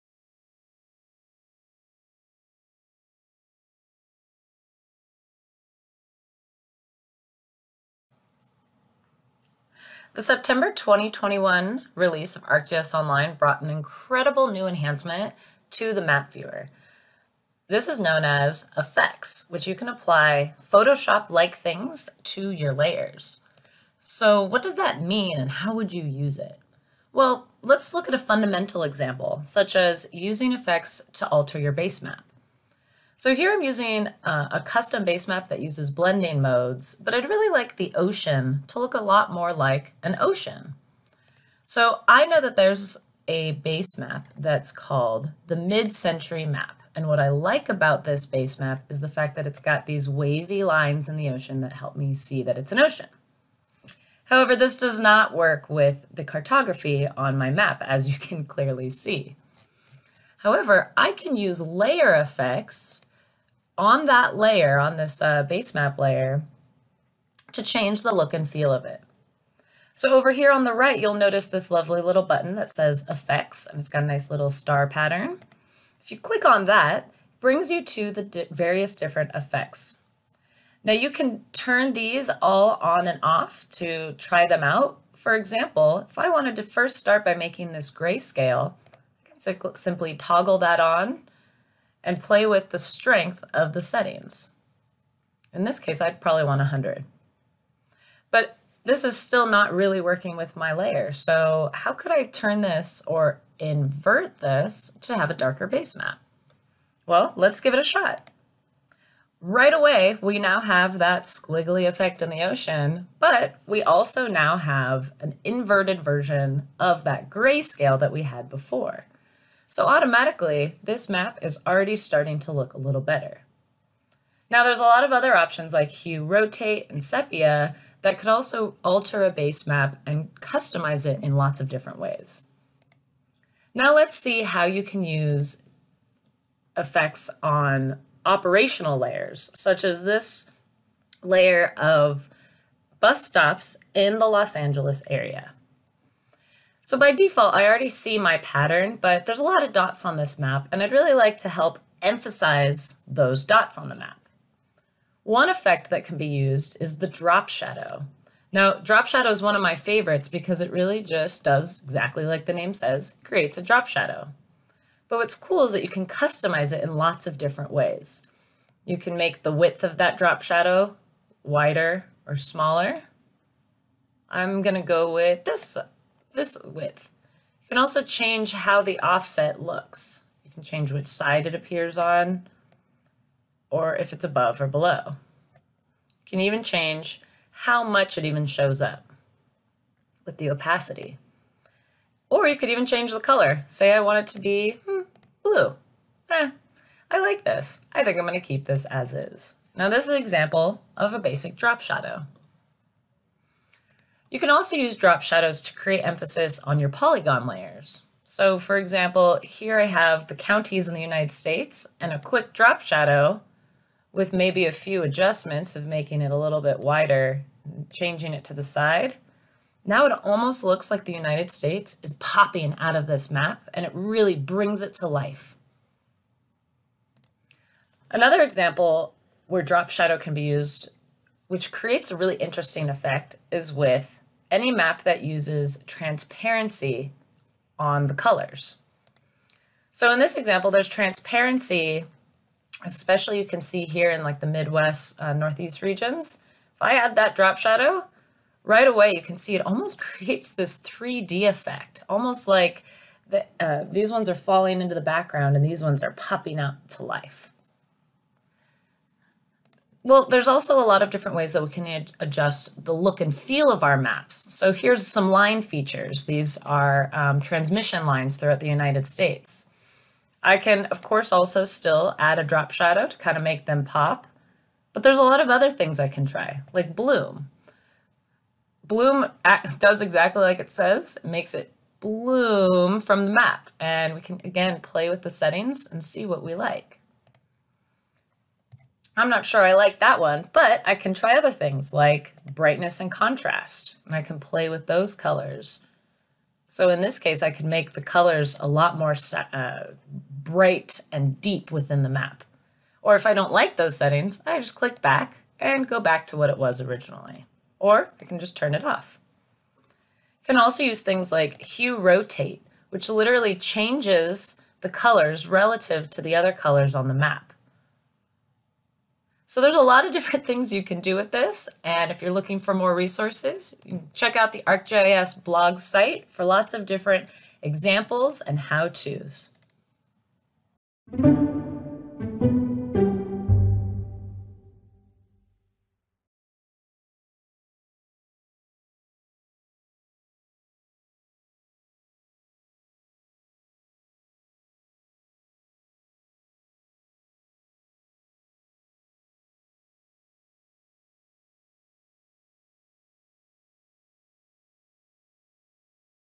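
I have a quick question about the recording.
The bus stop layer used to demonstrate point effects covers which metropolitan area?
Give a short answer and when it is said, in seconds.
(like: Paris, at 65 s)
Los Angeles, at 144 s.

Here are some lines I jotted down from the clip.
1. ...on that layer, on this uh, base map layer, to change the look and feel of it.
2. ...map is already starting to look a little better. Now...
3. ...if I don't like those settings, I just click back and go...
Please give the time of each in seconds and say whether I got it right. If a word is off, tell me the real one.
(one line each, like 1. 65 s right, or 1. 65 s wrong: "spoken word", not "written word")
1. 63 s right
2. 121 s right
3. 303 s right.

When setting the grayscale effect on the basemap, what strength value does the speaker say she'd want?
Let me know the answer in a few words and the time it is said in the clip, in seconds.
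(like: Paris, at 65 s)
100, at 96 s.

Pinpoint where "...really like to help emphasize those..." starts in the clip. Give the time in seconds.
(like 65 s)
150 s.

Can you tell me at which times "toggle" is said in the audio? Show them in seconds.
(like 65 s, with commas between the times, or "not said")
90 s.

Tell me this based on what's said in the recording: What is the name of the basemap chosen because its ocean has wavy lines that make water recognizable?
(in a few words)
mid-century map.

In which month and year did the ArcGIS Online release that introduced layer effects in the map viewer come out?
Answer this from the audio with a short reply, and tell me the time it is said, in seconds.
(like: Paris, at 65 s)
September 2021, at 10 s.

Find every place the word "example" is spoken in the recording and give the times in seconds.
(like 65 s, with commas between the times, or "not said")
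28 s, 85 s, 200 s, 208 s, 228 s, 240 s, 327 s.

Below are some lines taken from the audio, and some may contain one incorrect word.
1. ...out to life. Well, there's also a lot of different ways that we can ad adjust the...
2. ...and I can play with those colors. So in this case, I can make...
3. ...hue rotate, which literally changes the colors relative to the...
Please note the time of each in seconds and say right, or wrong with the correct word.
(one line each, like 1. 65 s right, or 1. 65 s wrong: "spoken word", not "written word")
1. 256 s right
2. 294 s right
3. 311 s right.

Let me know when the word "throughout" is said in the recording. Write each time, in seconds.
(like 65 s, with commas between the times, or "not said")
268 s.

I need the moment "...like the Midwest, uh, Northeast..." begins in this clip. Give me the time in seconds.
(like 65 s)
244 s.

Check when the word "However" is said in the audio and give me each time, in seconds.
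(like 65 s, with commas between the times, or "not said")
54 s, 60 s.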